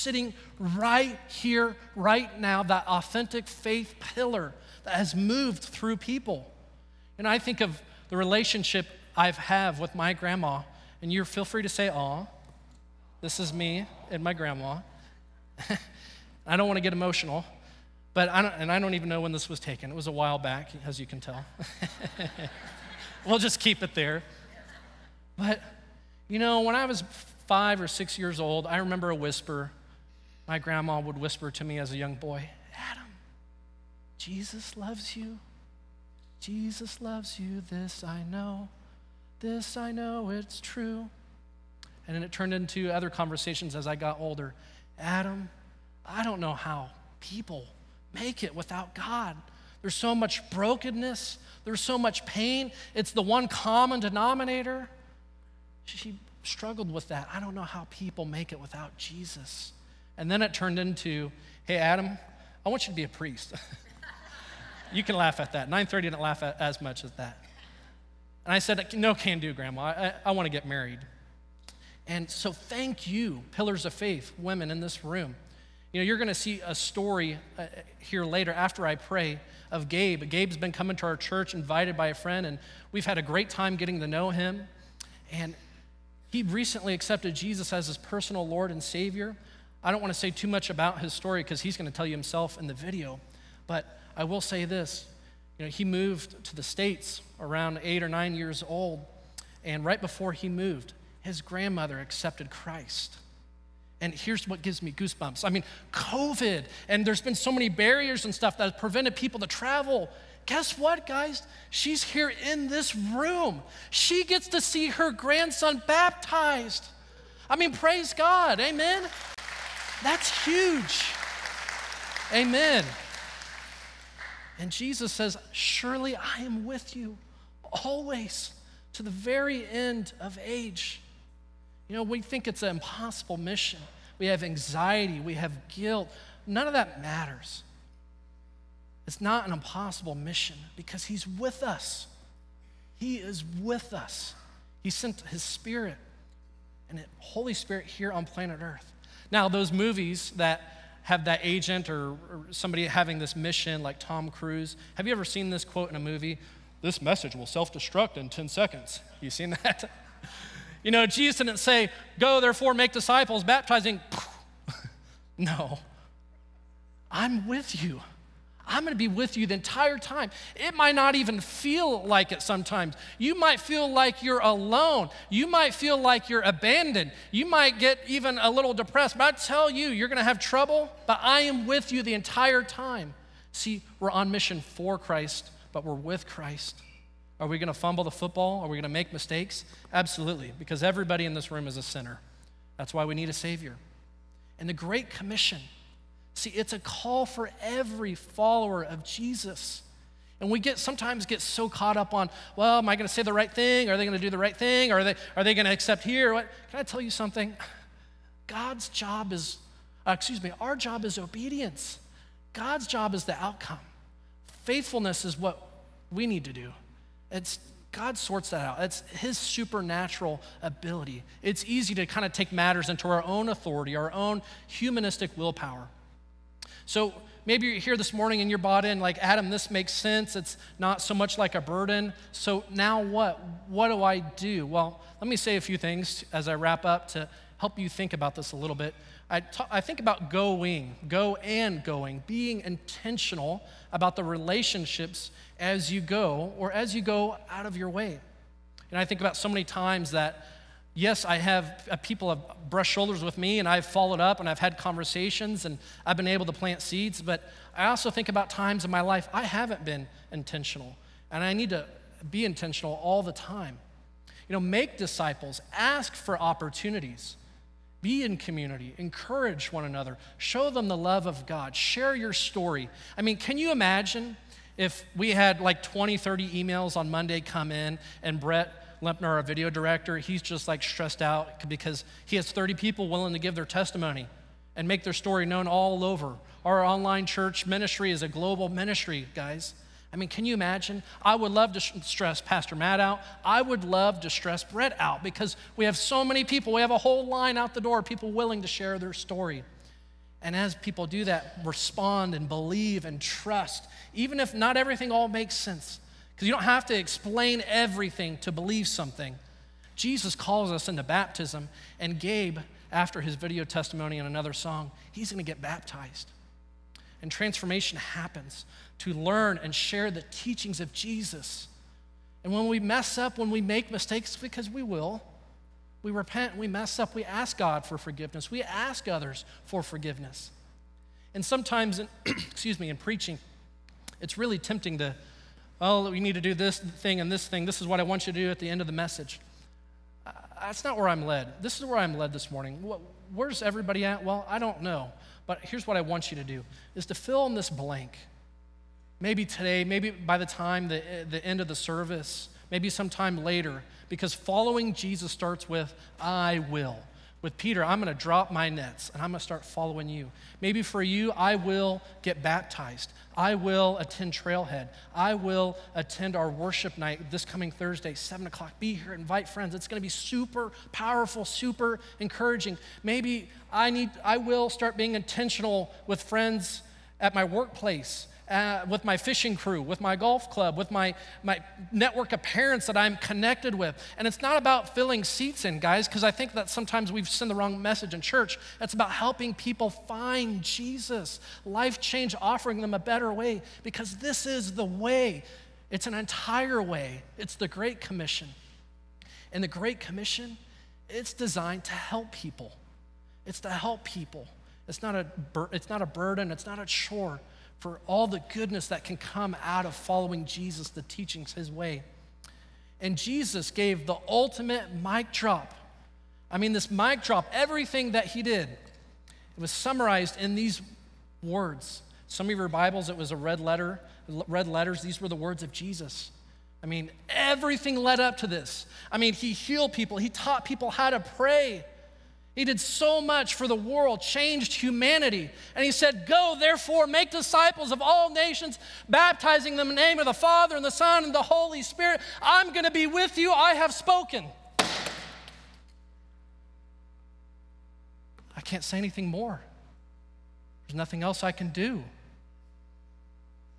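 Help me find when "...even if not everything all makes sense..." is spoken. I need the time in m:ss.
5:04.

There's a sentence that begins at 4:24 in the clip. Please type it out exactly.
You know, make disciples, ask for opportunities, be in community, encourage one another, show them the love of God, share your story.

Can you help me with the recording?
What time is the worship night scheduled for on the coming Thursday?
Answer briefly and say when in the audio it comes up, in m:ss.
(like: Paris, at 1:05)
7 o'clock, at 6:08.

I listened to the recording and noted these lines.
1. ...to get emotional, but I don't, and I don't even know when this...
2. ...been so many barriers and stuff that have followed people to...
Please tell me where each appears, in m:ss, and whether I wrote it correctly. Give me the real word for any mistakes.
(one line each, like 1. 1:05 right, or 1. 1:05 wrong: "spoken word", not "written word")
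1. 0:16 right
2. 1:47 wrong: "prevented", not "followed".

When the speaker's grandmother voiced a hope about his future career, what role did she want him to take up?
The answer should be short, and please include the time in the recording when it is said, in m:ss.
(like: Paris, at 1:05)
Priest, at 1:03.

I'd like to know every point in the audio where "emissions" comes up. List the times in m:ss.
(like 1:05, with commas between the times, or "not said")
not said.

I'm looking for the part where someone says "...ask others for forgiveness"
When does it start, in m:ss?
5:28.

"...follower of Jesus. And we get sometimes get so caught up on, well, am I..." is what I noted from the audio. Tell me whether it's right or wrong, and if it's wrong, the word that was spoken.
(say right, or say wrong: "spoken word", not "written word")
right.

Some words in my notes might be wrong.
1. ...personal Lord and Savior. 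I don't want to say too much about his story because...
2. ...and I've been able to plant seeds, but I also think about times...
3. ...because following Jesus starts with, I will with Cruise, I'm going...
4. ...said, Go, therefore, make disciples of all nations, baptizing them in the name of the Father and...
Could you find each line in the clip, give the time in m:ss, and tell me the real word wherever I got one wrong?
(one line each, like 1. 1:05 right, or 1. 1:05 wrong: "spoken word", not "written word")
1. 1:27 right
2. 4:15 right
3. 5:54 wrong: "Peter", not "Cruise"
4. 7:15 right.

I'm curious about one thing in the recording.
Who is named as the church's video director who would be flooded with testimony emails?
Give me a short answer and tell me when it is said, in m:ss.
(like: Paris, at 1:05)
Brett Lempner, at 4:38.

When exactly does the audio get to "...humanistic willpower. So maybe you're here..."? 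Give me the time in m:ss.
3:44.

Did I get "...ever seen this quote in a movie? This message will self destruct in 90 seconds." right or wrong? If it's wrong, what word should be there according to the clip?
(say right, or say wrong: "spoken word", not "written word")
wrong: "10", not "90".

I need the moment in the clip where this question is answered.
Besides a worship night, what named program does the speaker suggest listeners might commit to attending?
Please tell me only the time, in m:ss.
6:04.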